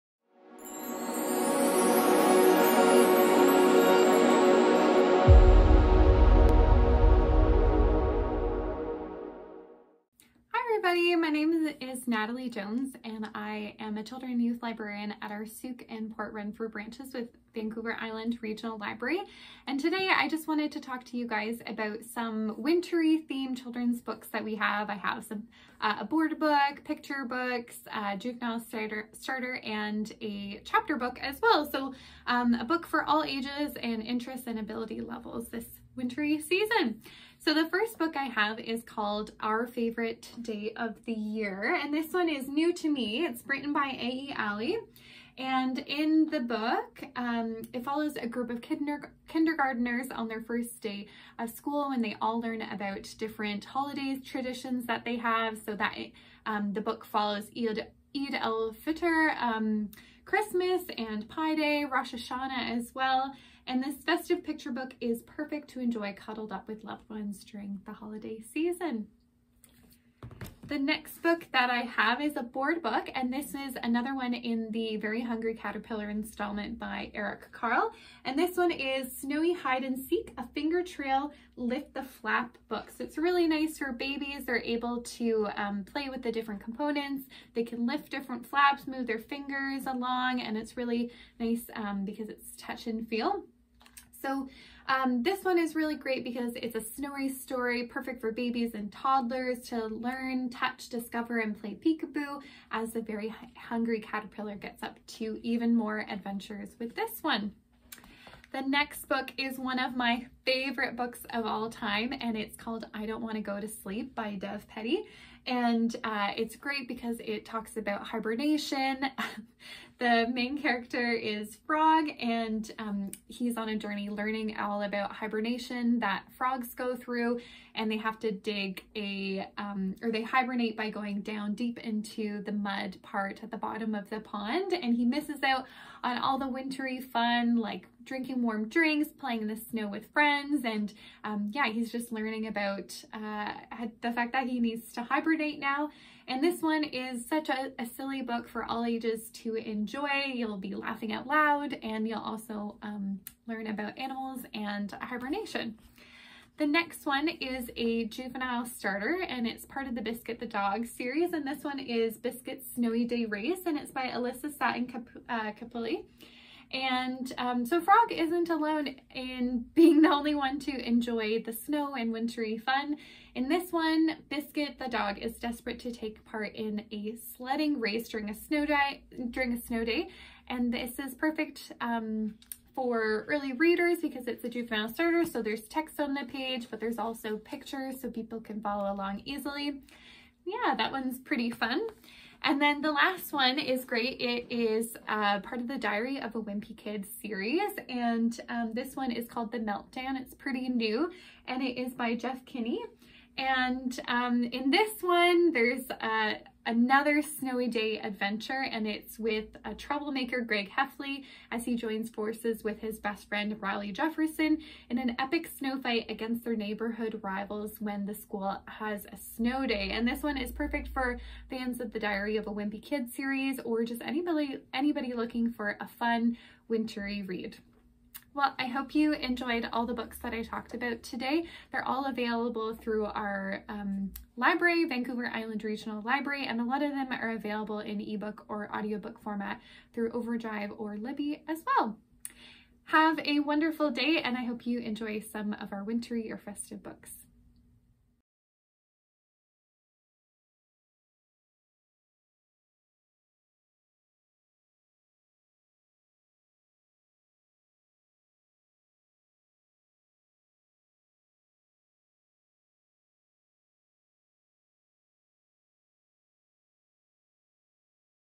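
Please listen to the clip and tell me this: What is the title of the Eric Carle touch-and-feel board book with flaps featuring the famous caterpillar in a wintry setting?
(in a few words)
Snowy Hide and Seek.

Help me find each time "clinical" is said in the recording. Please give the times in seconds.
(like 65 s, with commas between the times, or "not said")
not said.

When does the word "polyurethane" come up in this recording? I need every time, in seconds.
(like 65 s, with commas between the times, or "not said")
not said.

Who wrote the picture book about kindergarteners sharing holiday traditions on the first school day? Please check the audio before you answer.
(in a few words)
A.E. Ali.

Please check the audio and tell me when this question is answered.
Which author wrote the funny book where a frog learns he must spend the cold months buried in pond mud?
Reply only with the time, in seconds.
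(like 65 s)
114 s.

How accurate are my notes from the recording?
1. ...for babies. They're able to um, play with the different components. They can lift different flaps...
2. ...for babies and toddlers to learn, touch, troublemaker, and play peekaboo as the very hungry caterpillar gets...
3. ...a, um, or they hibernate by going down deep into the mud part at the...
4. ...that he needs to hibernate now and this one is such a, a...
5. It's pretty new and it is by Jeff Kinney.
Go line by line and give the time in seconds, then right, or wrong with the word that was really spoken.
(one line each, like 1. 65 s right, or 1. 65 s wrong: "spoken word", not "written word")
1. 83 s right
2. 98 s wrong: "discover", not "troublemaker"
3. 128 s right
4. 144 s right
5. 200 s right.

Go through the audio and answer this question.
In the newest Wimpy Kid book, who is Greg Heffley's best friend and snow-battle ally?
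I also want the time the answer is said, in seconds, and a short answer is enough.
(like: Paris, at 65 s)
Riley Jefferson, at 213 s.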